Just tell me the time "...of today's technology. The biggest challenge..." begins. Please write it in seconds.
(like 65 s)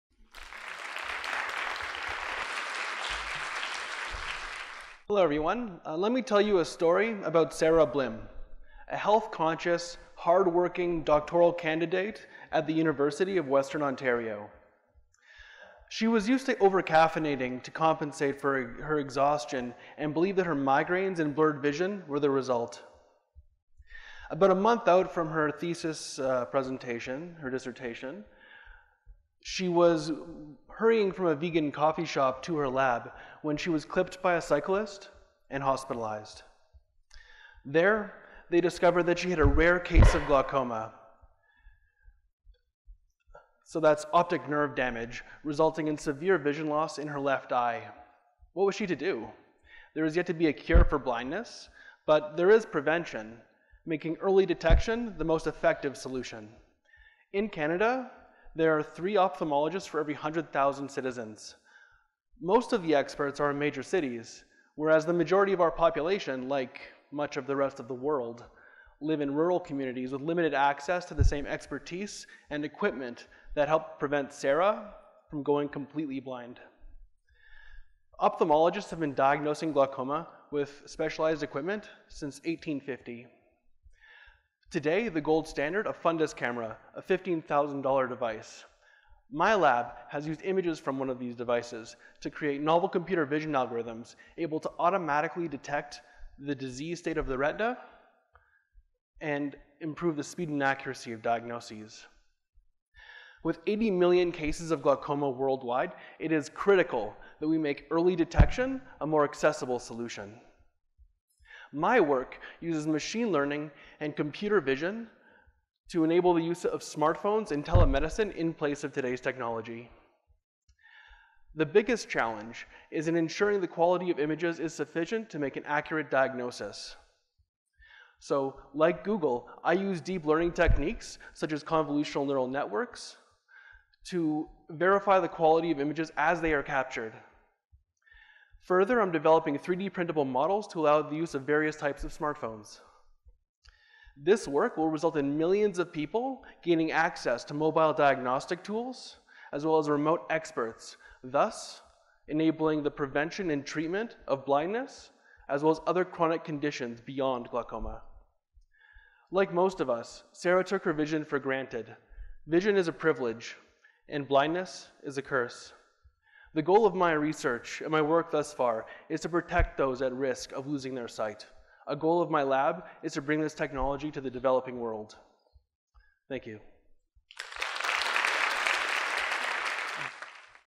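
118 s.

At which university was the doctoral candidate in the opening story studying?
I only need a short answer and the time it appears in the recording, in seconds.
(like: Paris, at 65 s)
University of Western Ontario, at 12 s.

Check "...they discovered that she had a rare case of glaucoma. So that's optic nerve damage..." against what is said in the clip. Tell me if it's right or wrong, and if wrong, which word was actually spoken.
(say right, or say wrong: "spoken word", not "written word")
right.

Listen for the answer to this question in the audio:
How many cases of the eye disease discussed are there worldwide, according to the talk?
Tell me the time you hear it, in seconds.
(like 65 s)
103 s.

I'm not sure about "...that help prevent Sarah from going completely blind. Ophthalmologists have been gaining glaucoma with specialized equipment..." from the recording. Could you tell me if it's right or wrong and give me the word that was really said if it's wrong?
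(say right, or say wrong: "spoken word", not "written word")
wrong: "diagnosing", not "gaining".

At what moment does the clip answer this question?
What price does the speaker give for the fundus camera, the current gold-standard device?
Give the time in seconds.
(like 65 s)
87 s.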